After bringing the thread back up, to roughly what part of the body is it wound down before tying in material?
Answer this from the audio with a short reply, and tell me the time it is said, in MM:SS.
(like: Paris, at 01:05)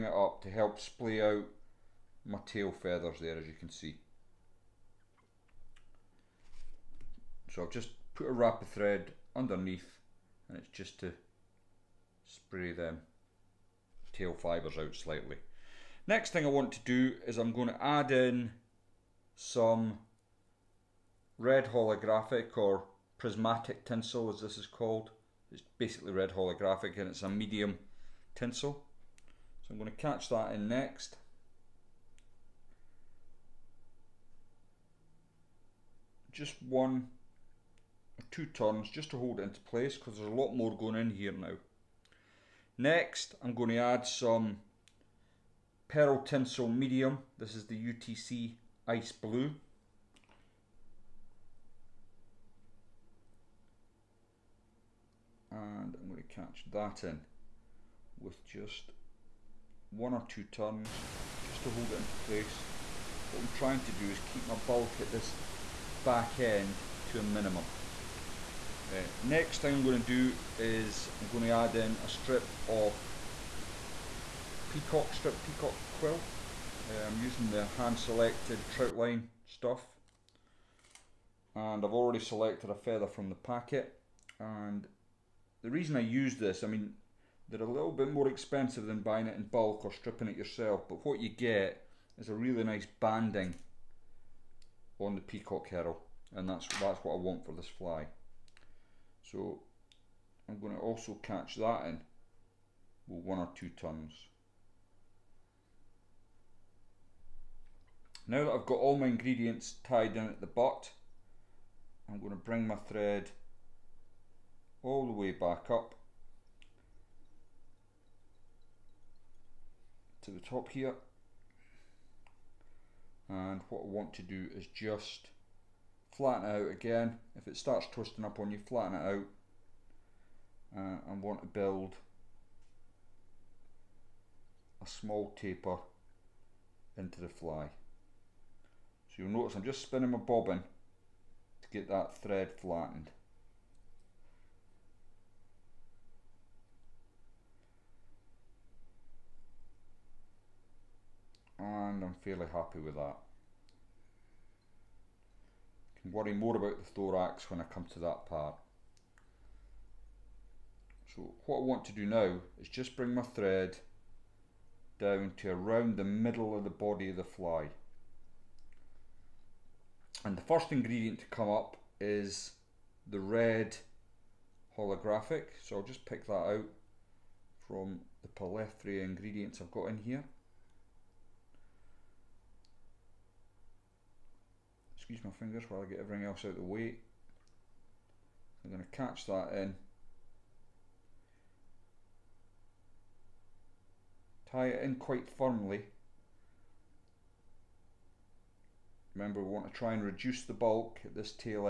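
The middle, at 02:46.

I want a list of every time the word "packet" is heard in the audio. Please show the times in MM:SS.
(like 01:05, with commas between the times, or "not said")
01:23.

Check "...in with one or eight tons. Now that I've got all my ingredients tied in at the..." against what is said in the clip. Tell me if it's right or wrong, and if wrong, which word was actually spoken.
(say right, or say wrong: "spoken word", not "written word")
wrong: "two", not "eight".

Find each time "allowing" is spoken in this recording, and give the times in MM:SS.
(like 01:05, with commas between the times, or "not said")
not said.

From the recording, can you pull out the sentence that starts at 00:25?
It's basically red holographic and it's a medium tinsel.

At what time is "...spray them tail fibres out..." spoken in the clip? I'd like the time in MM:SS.
00:12.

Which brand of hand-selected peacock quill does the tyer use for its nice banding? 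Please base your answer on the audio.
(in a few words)
Troutline.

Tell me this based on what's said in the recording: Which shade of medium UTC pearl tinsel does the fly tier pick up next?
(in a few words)
Ice Blue.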